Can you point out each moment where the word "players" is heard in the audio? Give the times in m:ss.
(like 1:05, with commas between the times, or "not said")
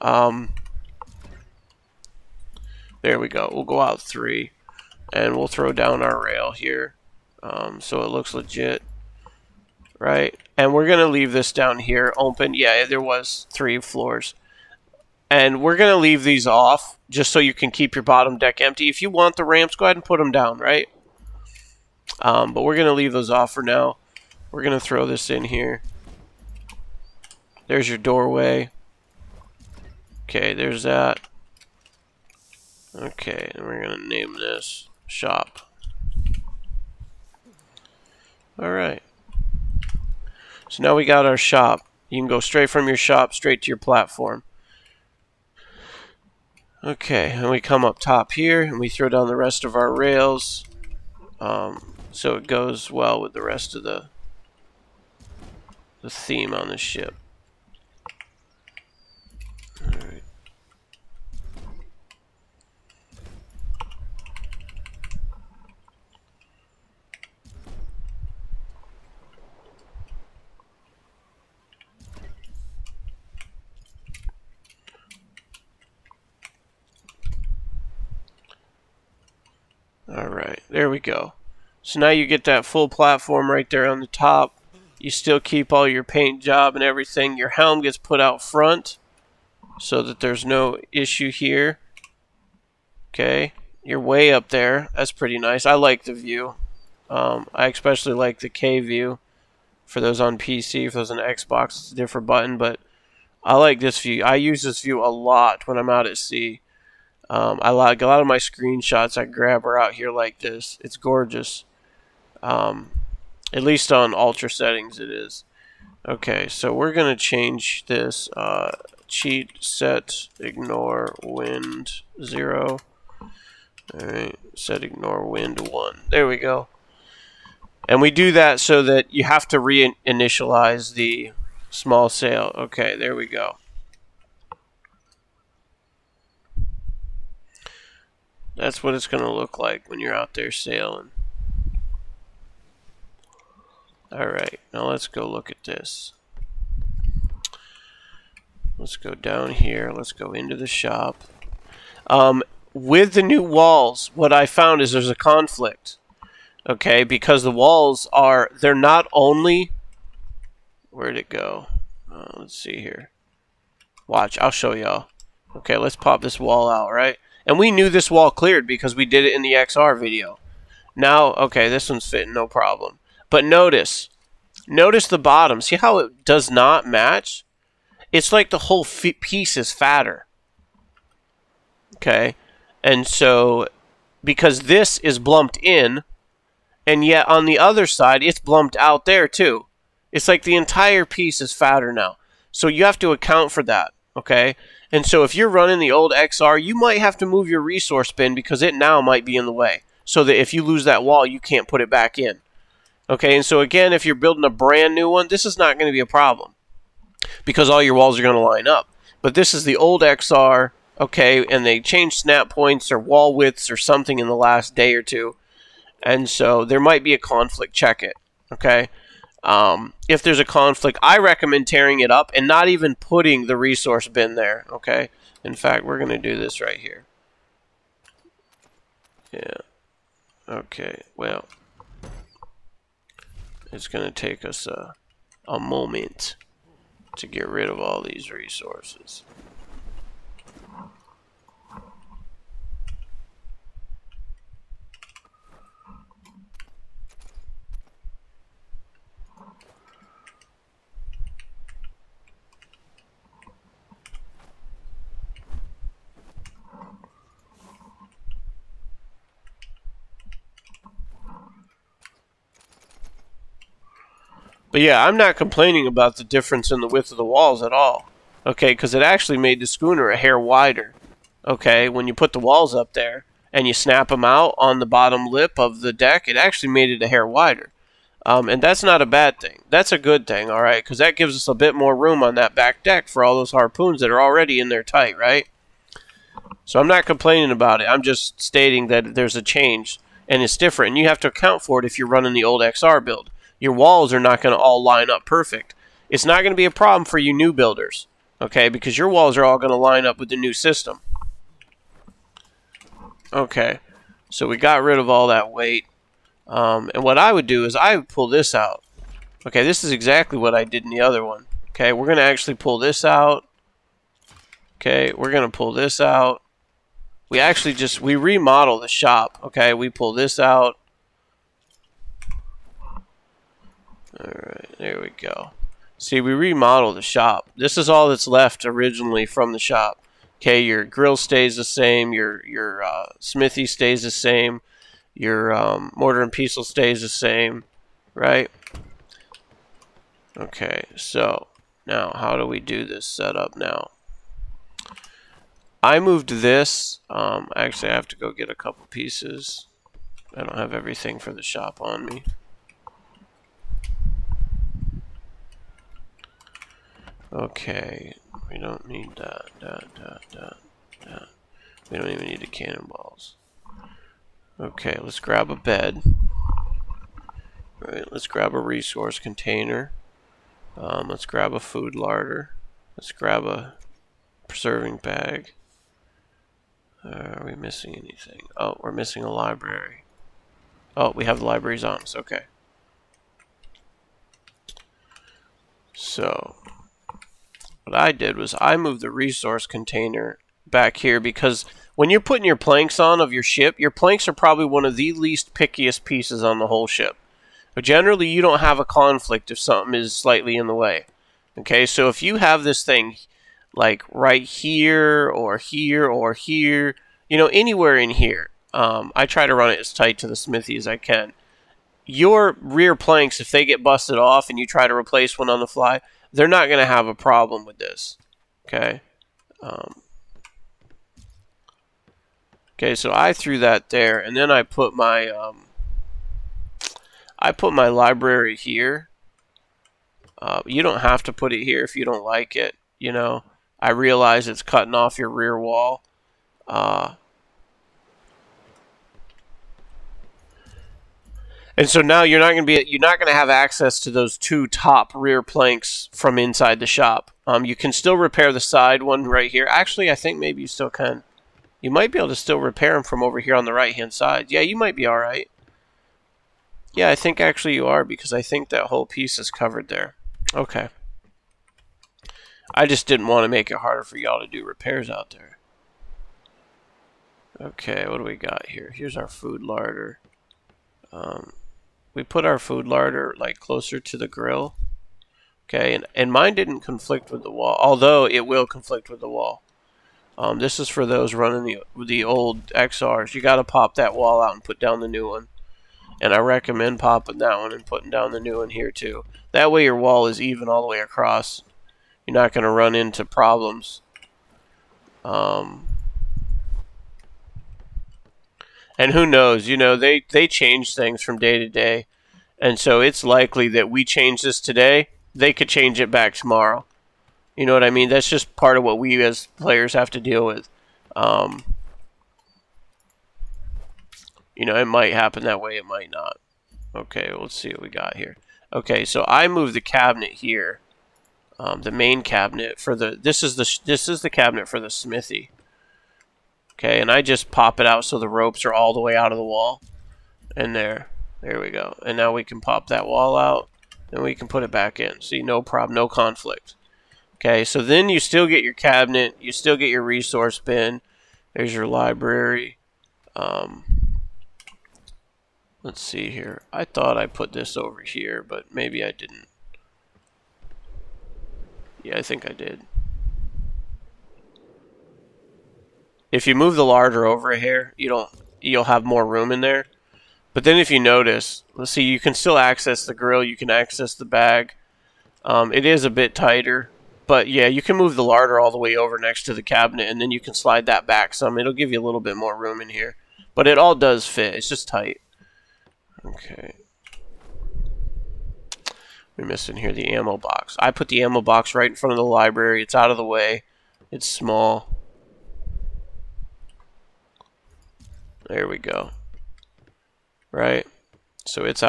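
8:29.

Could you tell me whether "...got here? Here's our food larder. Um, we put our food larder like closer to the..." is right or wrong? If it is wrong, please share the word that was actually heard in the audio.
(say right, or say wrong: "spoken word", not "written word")
right.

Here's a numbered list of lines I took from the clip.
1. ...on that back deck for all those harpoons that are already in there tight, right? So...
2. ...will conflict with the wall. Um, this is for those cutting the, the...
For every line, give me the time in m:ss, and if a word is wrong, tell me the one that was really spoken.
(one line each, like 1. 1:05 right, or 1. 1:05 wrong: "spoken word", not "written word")
1. 4:42 right
2. 7:58 wrong: "running", not "cutting".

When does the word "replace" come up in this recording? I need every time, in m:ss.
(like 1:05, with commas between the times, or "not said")
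6:54.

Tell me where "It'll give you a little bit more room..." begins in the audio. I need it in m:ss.
9:31.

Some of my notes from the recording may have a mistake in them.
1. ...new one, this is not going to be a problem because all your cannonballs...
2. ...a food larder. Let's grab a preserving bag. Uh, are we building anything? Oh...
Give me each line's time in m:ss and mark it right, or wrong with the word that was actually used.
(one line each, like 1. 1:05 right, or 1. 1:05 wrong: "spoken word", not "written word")
1. 3:24 wrong: "walls", not "cannonballs"
2. 6:11 wrong: "missing", not "building".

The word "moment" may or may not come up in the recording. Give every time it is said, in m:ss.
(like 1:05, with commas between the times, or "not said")
3:55.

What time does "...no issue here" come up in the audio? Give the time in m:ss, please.
1:30.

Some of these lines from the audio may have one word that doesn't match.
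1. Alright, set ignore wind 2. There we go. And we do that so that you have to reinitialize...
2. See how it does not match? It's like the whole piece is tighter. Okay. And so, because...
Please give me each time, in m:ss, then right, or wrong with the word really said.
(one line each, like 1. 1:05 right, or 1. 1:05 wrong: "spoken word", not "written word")
1. 2:03 wrong: "1", not "2"
2. 2:55 wrong: "fatter", not "tighter".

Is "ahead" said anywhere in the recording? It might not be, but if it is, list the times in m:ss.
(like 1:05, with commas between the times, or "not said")
0:19.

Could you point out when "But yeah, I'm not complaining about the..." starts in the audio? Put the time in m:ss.
4:24.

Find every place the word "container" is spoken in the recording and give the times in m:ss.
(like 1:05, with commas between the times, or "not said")
6:09, 6:29.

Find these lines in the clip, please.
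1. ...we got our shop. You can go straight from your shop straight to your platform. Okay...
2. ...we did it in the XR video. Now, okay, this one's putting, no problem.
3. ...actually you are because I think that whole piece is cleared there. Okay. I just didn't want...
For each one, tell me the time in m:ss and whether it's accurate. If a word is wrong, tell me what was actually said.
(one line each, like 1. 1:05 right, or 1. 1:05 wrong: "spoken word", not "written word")
1. 0:40 right
2. 2:48 wrong: "fitting", not "putting"
3. 7:37 wrong: "covered", not "cleared".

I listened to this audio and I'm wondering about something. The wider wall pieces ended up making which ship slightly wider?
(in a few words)
schooner.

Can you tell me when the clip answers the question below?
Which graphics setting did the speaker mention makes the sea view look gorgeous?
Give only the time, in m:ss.
1:54.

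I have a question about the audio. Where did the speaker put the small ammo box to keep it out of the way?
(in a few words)
in front of the library.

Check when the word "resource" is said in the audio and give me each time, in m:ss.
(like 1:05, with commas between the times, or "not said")
3:17, 3:43, 3:58, 6:08, 6:29, 9:00.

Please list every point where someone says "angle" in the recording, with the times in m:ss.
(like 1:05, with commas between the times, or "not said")
not said.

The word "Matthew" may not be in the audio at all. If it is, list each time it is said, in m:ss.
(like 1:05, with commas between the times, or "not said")
not said.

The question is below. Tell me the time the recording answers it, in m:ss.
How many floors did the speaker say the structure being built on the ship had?
0:13.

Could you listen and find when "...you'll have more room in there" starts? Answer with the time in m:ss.
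9:18.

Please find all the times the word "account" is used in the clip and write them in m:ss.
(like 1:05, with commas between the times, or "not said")
3:13, 4:51.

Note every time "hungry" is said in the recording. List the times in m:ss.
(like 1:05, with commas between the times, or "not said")
not said.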